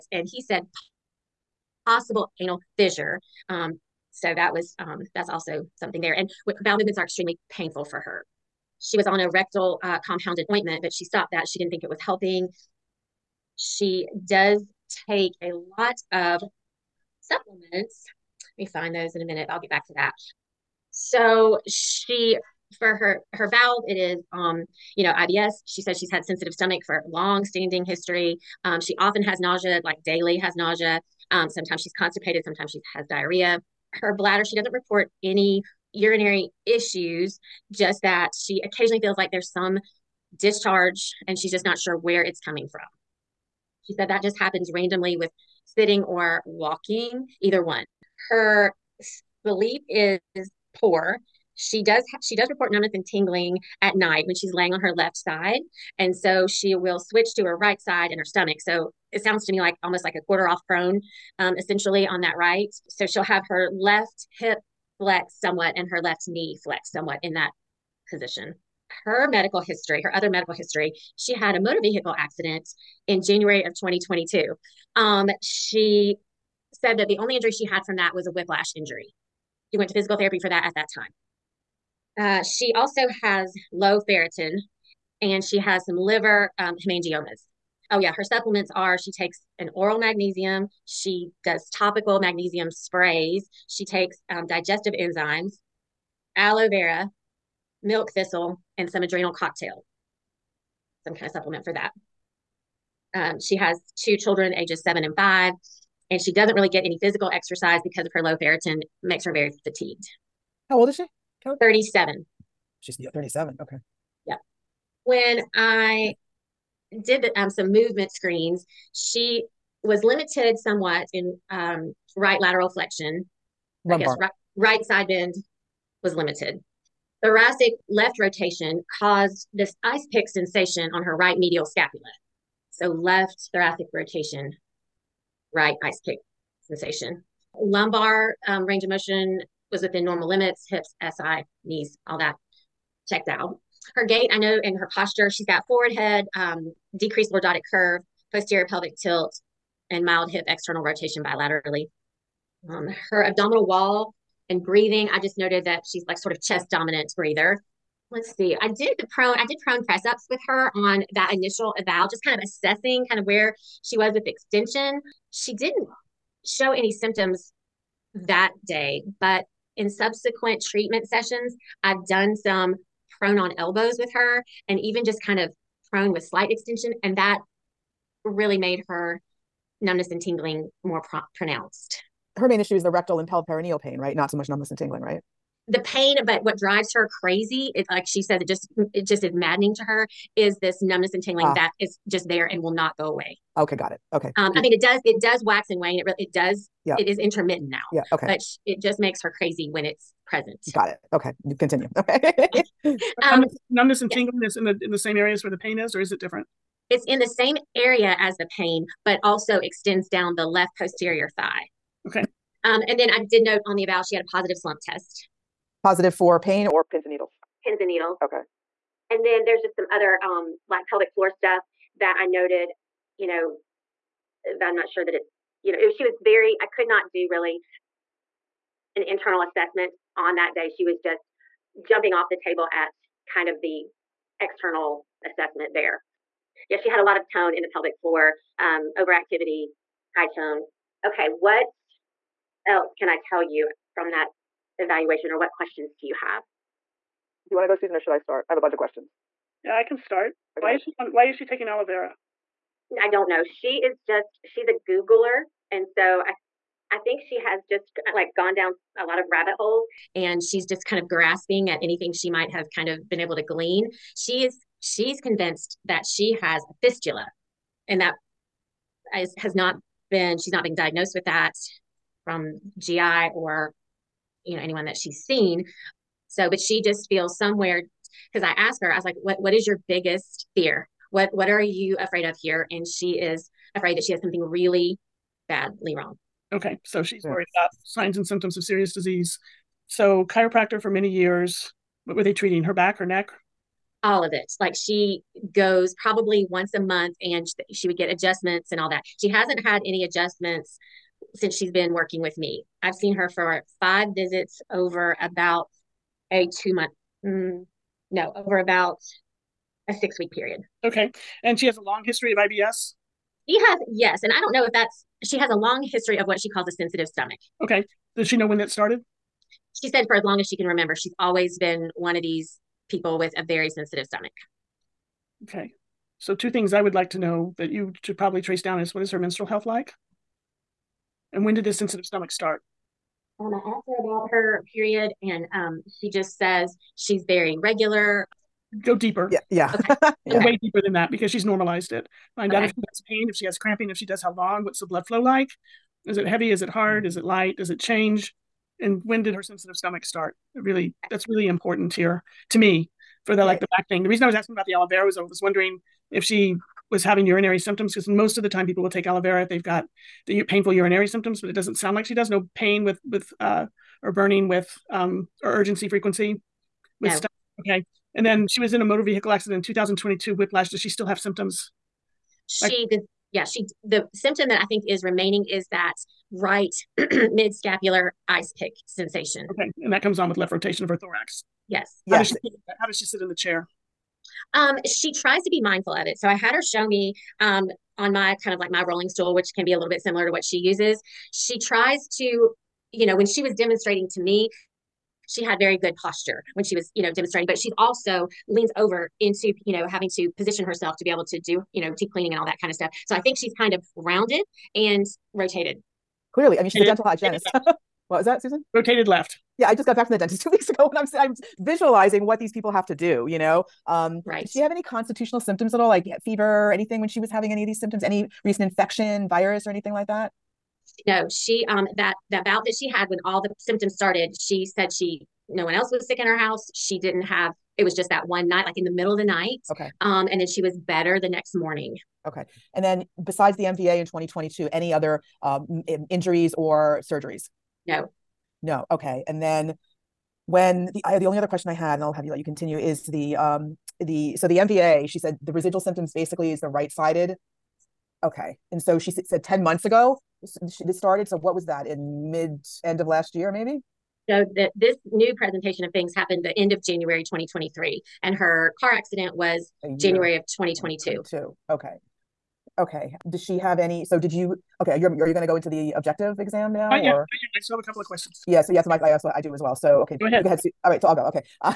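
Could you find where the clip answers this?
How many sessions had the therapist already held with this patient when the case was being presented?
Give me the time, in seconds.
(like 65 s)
303 s.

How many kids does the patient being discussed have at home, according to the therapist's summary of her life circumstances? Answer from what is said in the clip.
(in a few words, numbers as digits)
2.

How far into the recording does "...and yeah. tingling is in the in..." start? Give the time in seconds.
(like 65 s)
204 s.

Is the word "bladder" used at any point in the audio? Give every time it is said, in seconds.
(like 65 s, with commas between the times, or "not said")
34 s.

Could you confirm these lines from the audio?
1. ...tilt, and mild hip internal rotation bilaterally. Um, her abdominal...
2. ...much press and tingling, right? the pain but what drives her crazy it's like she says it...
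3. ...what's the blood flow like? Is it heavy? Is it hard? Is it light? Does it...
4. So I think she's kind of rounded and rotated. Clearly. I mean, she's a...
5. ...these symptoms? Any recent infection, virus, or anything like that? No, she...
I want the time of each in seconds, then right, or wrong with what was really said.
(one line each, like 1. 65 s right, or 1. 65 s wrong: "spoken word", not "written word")
1. 148 s wrong: "external", not "internal"
2. 184 s wrong: "numbness", not "press"
3. 344 s right
4. 403 s right
5. 417 s right.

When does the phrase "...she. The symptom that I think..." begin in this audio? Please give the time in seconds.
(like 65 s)
373 s.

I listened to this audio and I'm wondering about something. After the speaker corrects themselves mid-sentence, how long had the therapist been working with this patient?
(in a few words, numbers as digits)
6 weeks.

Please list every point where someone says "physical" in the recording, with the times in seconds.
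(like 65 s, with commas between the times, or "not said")
79 s, 107 s.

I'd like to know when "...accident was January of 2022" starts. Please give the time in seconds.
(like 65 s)
458 s.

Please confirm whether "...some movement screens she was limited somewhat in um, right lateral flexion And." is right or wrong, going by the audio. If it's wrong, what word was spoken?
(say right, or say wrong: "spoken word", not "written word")
wrong: "Lumbar", not "And".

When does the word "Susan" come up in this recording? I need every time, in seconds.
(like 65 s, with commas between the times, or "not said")
247 s, 408 s.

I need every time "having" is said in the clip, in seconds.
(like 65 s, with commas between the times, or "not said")
357 s, 399 s, 417 s.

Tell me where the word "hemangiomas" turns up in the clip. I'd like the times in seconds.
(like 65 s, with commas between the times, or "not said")
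86 s.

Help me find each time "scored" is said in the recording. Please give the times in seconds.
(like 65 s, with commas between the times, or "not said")
not said.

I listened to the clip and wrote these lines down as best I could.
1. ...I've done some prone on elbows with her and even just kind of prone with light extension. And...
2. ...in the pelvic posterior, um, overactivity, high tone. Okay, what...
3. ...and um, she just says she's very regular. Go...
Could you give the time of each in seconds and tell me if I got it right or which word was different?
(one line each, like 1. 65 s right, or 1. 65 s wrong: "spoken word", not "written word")
1. 171 s wrong: "slight", not "light"
2. 237 s wrong: "floor", not "posterior"
3. 335 s right.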